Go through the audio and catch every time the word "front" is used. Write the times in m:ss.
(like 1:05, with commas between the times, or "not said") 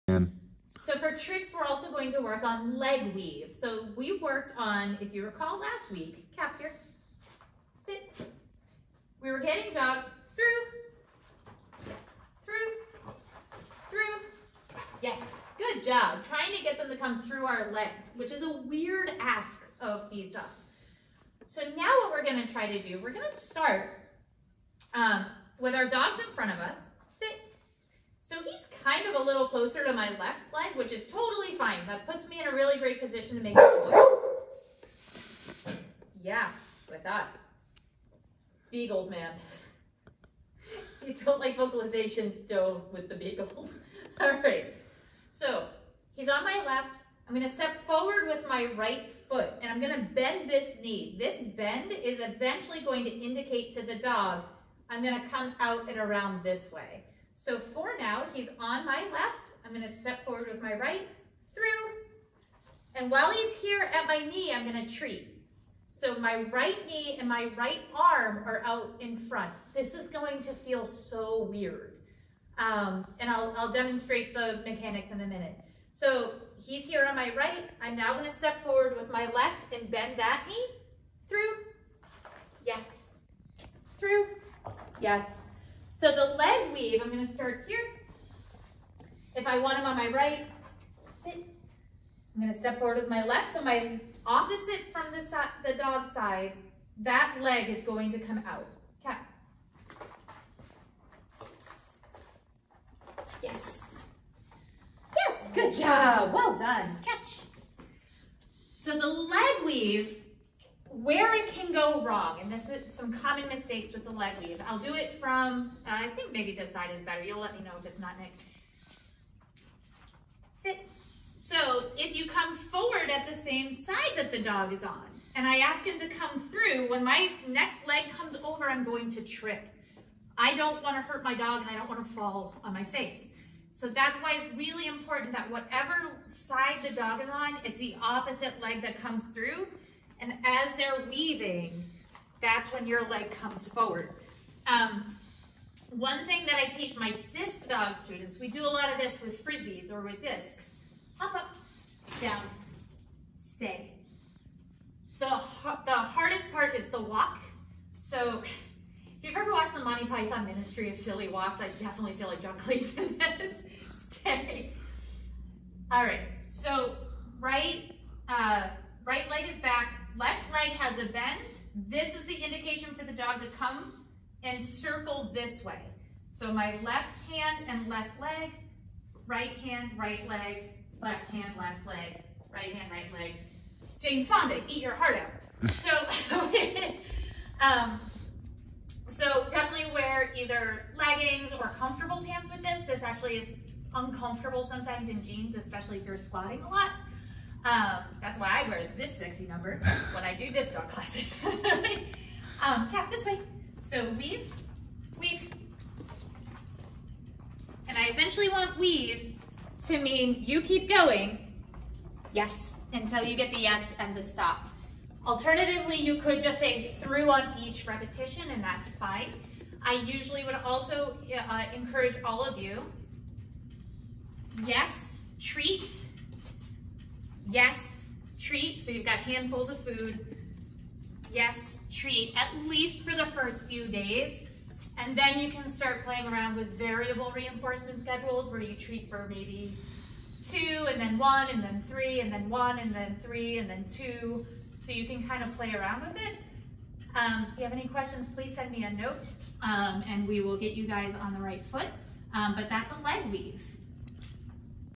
0:26, 1:09.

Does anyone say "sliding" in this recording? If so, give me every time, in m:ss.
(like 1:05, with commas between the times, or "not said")
not said.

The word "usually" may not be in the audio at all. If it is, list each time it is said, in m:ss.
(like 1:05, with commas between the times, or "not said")
3:39.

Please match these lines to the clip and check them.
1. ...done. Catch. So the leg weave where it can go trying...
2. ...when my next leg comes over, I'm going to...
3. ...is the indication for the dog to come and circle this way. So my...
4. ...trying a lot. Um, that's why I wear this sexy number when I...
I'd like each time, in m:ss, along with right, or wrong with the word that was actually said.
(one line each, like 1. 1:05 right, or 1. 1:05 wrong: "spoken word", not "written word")
1. 1:46 wrong: "wrong", not "trying"
2. 2:06 right
3. 2:52 right
4. 3:16 wrong: "squatting", not "trying".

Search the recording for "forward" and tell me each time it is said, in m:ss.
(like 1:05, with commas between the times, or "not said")
0:47, 1:00, 1:18, 1:32, 2:02, 2:23.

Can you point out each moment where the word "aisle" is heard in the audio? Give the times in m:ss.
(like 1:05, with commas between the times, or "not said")
not said.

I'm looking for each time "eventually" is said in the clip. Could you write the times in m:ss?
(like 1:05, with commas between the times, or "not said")
0:52, 3:28.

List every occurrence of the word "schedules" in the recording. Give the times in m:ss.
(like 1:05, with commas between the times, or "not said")
3:58.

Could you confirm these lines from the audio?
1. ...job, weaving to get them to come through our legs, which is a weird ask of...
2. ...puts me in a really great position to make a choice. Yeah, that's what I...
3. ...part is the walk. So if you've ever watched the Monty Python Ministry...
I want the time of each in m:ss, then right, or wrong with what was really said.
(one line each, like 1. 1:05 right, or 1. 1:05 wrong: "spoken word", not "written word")
1. 0:15 wrong: "trying", not "weaving"
2. 0:32 right
3. 2:36 right.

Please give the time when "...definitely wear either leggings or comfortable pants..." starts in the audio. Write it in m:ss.
3:09.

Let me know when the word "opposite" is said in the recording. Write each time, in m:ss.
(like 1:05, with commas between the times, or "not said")
1:34, 2:18.